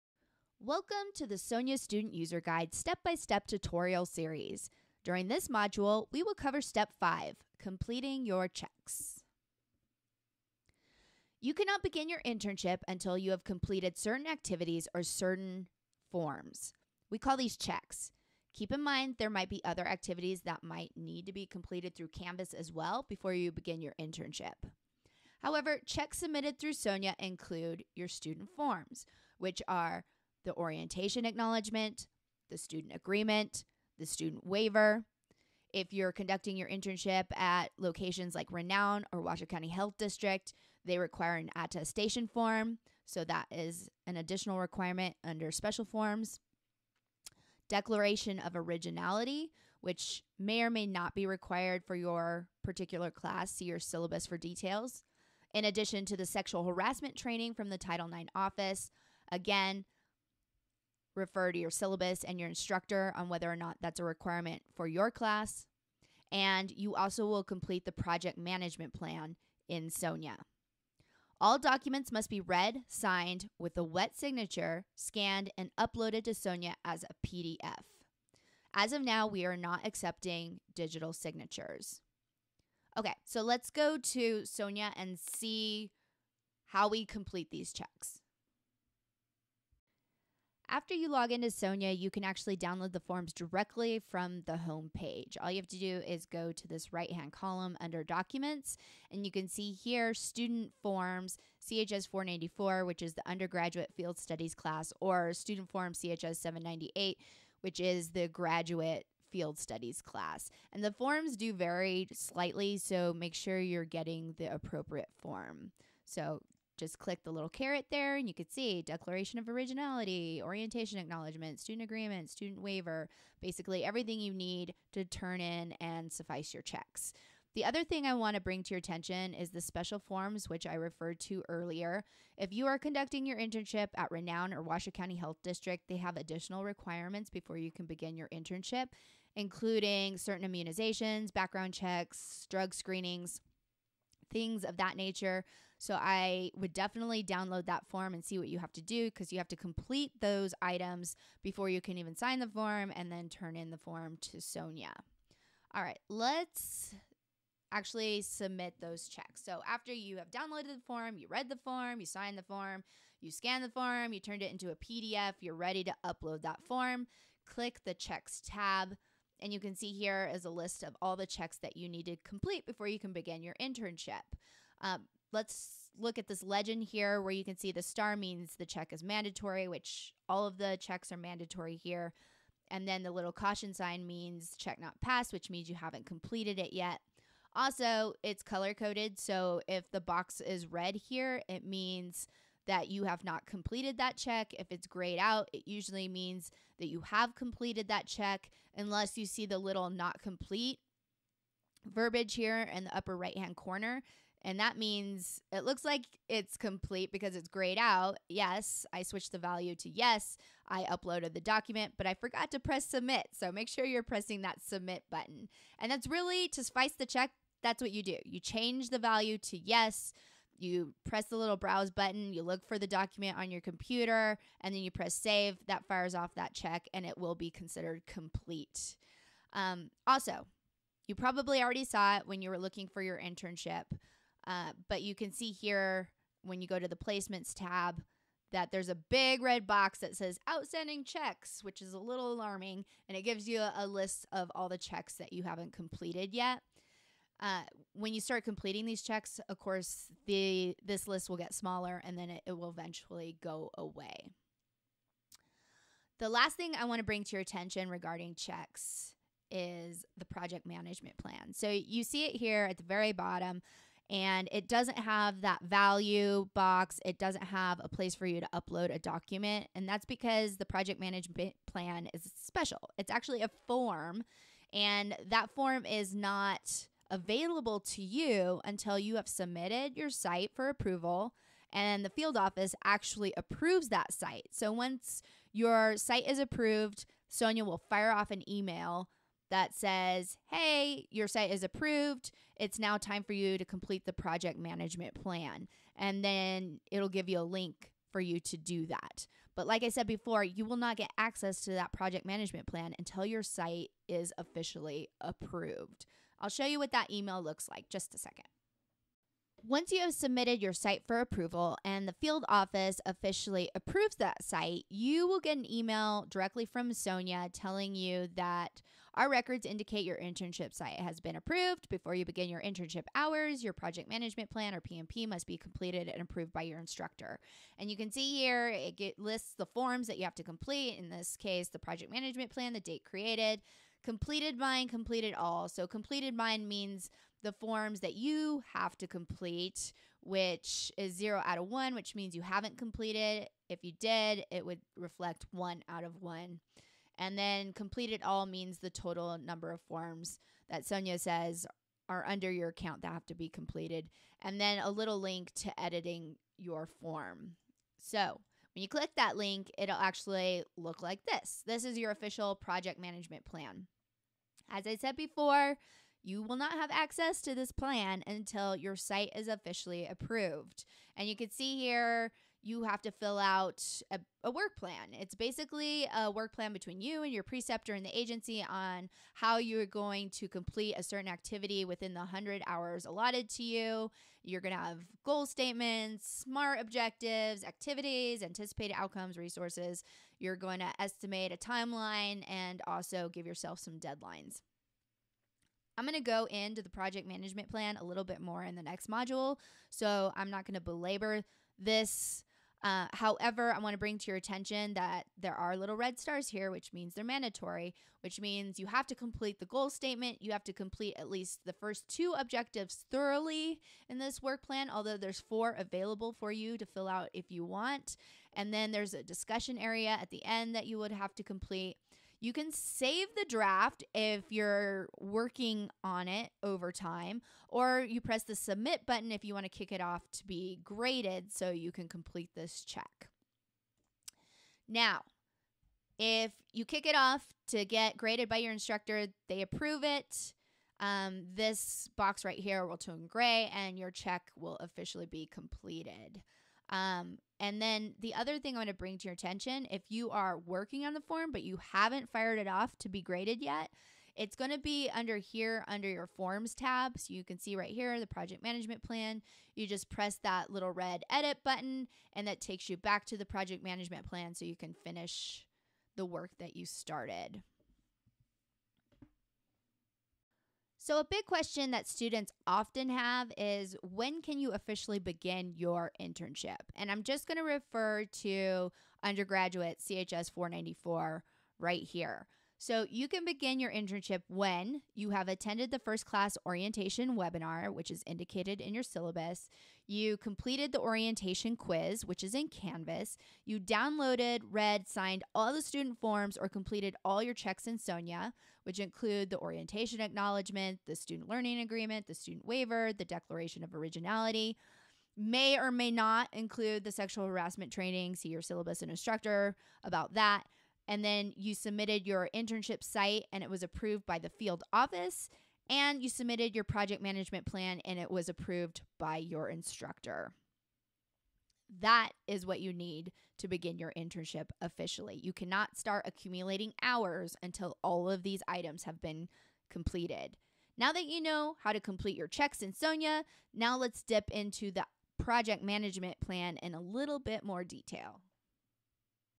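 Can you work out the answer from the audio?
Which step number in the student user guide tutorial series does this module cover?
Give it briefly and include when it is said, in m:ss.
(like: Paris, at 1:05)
5, at 0:06.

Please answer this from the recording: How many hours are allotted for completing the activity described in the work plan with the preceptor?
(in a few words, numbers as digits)
100.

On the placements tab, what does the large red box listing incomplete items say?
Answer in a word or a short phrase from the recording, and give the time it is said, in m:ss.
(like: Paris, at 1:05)
outstanding checks, at 4:00.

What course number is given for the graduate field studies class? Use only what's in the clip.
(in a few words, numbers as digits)
CHS 798.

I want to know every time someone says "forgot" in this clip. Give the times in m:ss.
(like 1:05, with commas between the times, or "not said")
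3:32.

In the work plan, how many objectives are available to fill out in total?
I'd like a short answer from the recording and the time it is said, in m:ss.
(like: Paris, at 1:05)
4, at 6:55.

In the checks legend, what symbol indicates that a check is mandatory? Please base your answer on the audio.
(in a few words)
star.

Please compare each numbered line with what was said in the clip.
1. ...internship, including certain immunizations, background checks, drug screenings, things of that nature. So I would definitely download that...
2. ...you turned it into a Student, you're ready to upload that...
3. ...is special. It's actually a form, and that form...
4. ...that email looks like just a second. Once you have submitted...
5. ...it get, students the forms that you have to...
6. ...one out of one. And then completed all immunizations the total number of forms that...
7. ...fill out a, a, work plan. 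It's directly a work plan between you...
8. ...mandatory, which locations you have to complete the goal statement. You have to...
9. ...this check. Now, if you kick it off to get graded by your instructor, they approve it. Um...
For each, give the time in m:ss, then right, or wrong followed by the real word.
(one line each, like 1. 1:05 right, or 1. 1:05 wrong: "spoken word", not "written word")
1. 2:18 right
2. 2:44 wrong: "PDF", not "Student"
3. 4:32 right
4. 5:06 right
5. 5:28 wrong: "lists", not "students"
6. 5:45 wrong: "means", not "immunizations"
7. 6:13 wrong: "basically", not "directly"
8. 6:47 wrong: "means", not "locations"
9. 7:12 right.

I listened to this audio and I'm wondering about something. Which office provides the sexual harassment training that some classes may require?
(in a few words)
Title IX office.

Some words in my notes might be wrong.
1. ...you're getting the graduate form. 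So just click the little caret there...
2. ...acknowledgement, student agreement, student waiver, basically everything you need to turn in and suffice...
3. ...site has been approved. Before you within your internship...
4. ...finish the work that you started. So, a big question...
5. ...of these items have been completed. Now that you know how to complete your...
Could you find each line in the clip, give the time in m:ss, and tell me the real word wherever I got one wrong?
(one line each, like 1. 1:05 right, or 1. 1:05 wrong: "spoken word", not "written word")
1. 1:53 wrong: "appropriate", not "graduate"
2. 2:00 right
3. 5:20 wrong: "begin", not "within"
4. 7:45 right
5. 8:48 right.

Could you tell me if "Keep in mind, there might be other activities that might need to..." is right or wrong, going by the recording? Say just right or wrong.
right.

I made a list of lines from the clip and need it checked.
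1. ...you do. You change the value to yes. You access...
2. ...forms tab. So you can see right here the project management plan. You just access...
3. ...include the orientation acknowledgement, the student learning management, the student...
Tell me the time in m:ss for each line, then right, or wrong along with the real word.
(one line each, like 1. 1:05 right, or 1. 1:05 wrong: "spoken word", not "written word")
1. 3:37 wrong: "press", not "access"
2. 7:36 wrong: "press", not "access"
3. 8:18 wrong: "agreement", not "management".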